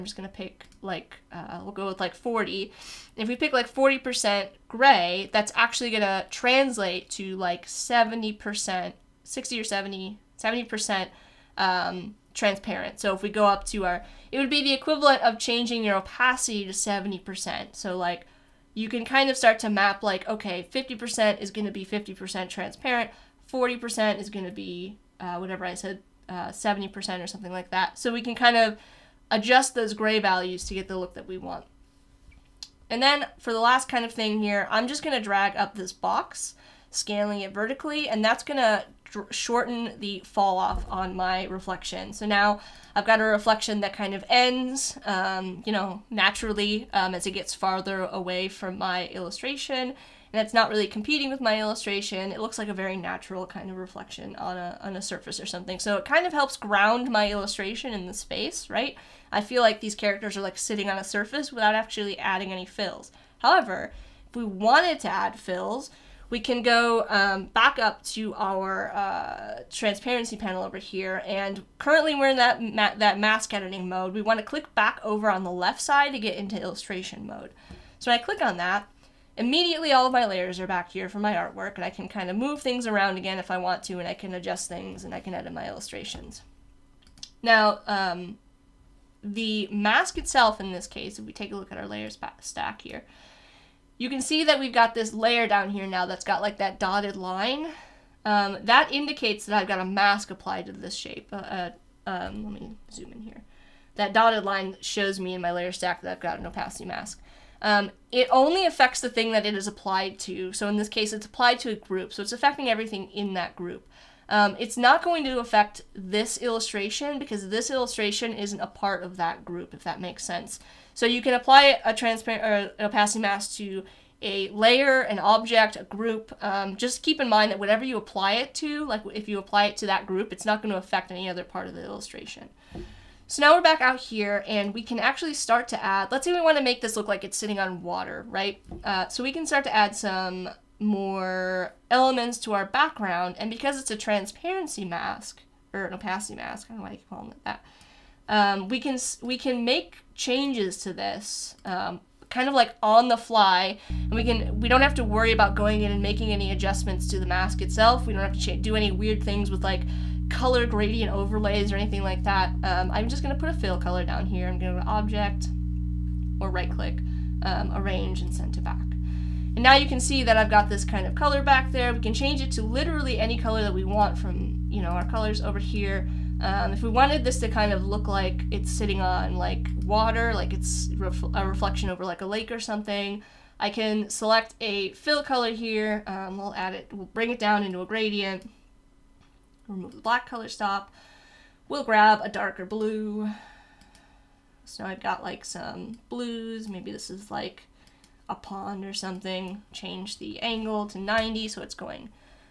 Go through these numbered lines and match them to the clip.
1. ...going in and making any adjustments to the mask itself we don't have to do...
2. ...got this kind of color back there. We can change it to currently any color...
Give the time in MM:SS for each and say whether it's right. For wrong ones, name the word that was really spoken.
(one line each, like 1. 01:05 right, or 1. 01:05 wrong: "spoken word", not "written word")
1. 02:35 right
2. 02:50 wrong: "literally", not "currently".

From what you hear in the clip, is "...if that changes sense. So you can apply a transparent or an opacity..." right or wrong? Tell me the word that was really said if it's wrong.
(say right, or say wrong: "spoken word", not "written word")
wrong: "makes", not "changes".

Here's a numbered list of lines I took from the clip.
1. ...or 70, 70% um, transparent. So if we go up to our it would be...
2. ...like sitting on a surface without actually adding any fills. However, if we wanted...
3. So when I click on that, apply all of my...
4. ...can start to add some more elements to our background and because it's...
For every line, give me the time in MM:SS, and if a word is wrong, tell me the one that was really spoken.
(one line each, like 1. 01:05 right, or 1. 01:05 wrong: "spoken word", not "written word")
1. 00:09 right
2. 01:00 right
3. 01:17 wrong: "immediately", not "apply"
4. 02:19 right.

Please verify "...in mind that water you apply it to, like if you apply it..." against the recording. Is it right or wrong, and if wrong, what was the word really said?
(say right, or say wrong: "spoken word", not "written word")
wrong: "whatever", not "water".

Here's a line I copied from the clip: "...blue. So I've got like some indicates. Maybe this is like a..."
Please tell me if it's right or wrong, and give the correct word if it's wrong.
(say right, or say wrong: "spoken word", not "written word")
wrong: "blues", not "indicates".